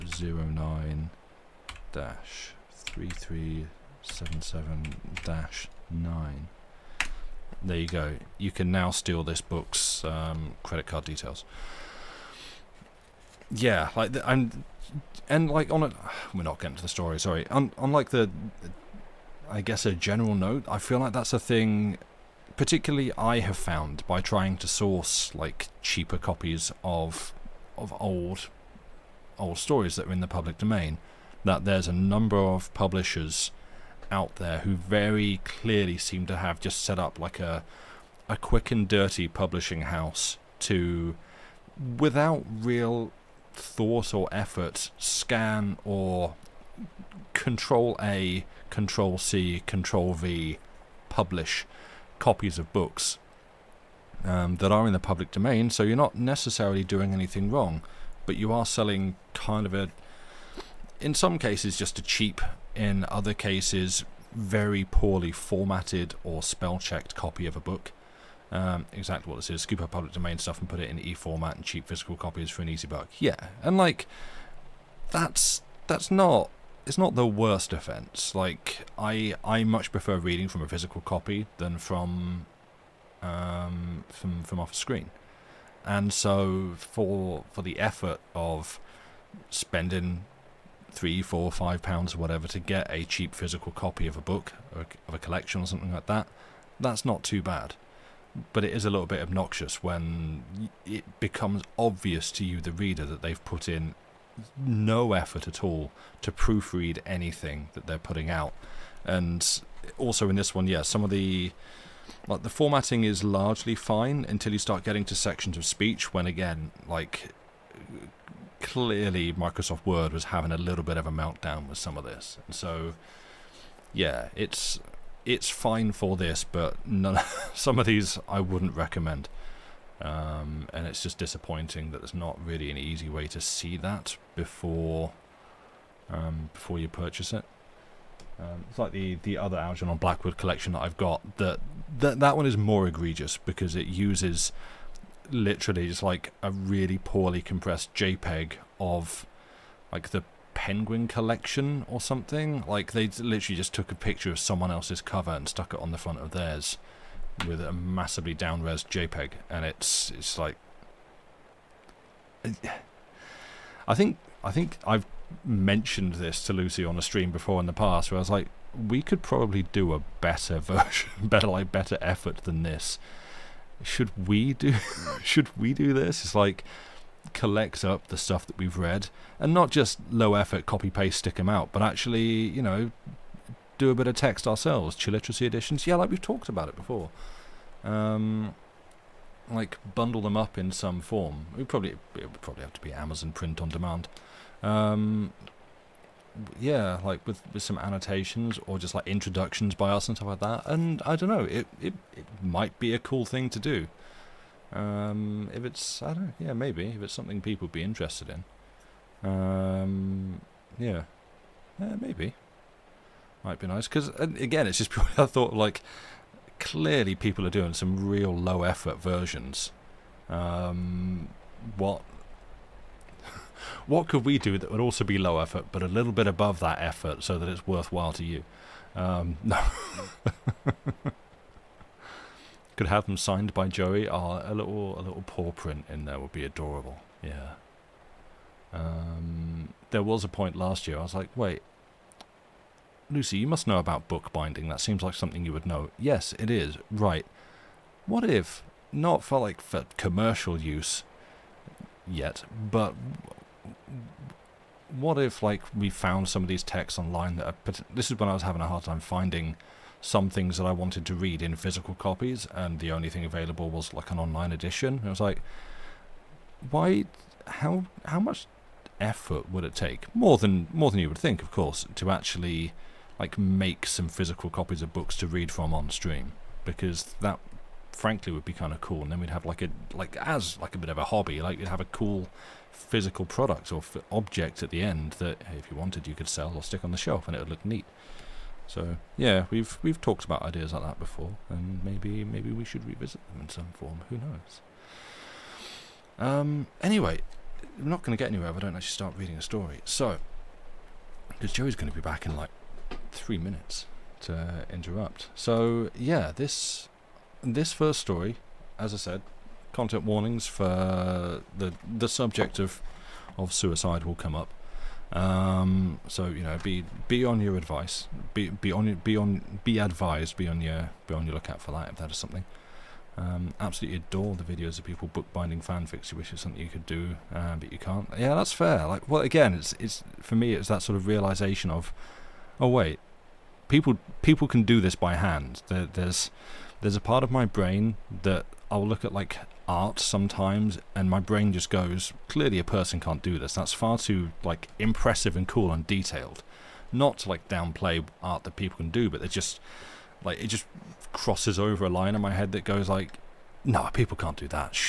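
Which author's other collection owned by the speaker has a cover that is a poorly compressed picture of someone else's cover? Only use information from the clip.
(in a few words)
Algernon Blackwood.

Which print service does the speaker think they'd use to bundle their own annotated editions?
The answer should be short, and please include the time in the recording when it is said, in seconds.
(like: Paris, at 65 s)
Amazon print on demand, at 192 s.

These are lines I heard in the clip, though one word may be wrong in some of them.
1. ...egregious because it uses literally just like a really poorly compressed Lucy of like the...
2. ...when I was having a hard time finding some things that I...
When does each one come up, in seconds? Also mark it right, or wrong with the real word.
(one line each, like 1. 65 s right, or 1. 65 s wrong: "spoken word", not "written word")
1. 142 s wrong: "JPEG", not "Lucy"
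2. 258 s right.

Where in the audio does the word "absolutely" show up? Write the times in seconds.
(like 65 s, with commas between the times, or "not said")
323 s.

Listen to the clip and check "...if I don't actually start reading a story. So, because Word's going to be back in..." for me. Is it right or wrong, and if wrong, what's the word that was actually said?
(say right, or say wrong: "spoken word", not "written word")
wrong: "Joey", not "Word".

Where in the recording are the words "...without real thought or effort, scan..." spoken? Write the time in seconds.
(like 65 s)
41 s.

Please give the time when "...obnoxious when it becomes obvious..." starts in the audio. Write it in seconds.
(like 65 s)
99 s.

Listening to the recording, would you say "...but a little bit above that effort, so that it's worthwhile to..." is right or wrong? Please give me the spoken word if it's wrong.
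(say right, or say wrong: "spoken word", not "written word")
right.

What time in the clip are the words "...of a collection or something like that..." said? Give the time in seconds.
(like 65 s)
95 s.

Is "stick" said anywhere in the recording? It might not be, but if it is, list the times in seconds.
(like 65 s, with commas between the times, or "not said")
181 s, 286 s.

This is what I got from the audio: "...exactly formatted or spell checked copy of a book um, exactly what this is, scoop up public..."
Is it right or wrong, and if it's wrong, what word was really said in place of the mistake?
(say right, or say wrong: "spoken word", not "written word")
wrong: "poorly", not "exactly".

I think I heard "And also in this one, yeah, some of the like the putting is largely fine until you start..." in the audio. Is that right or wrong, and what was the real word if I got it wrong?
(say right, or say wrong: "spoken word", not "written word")
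wrong: "formatting", not "putting".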